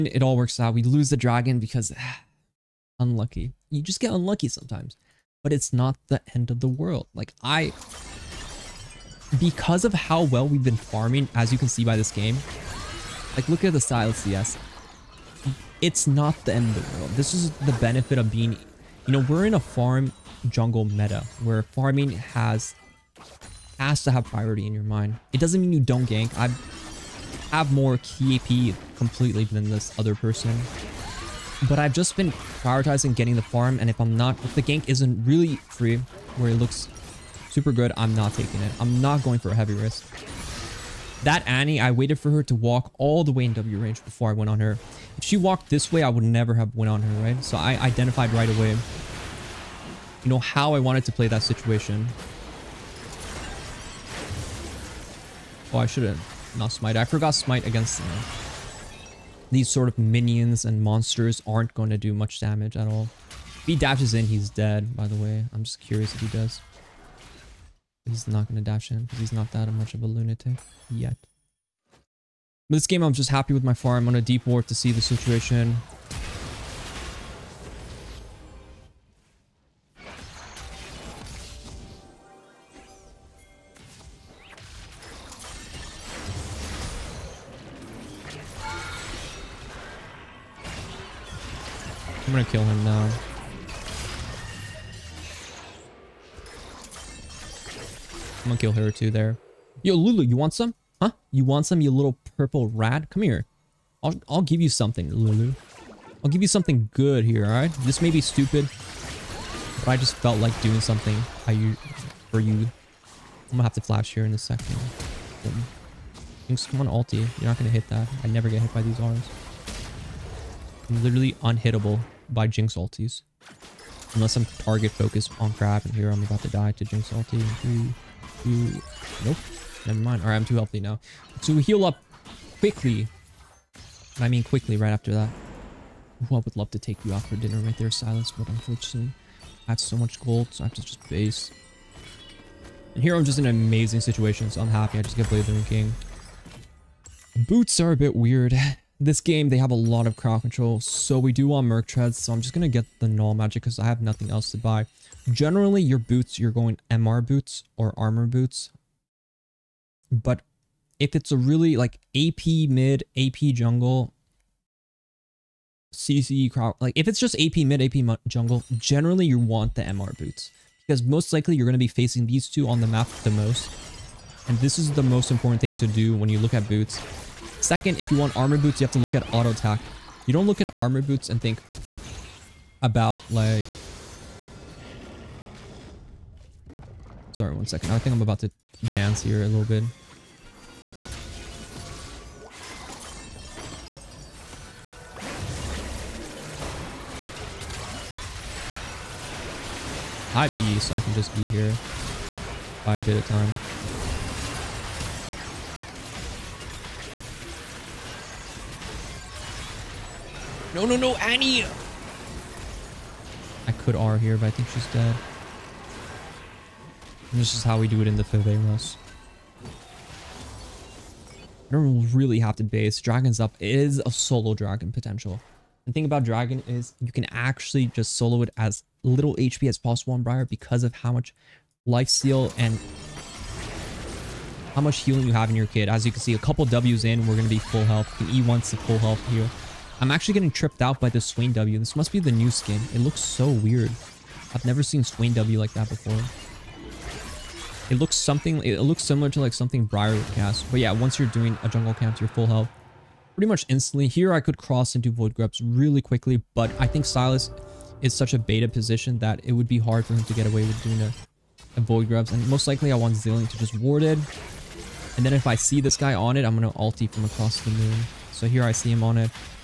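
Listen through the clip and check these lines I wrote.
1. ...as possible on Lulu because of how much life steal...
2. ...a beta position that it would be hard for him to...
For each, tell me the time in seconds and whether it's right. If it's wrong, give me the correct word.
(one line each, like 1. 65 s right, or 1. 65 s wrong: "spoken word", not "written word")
1. 229 s wrong: "Briar", not "Lulu"
2. 258 s right.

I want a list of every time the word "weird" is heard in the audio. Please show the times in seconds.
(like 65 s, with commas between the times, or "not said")
148 s, 243 s.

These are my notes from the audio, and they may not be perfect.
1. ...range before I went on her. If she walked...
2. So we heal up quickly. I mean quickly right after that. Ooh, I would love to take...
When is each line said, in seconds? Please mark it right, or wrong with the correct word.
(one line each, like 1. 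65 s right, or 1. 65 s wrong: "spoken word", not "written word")
1. 43 s right
2. 131 s right.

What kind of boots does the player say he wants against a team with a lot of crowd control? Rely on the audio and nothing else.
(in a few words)
Merc Treads.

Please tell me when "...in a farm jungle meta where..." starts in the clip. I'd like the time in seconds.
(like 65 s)
19 s.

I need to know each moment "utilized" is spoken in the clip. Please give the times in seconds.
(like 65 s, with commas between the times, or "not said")
not said.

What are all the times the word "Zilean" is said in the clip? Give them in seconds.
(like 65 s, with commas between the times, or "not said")
263 s.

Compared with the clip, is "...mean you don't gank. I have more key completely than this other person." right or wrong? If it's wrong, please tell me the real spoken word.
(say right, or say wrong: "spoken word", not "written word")
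right.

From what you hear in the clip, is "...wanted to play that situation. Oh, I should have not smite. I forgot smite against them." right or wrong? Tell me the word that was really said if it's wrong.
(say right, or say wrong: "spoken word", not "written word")
right.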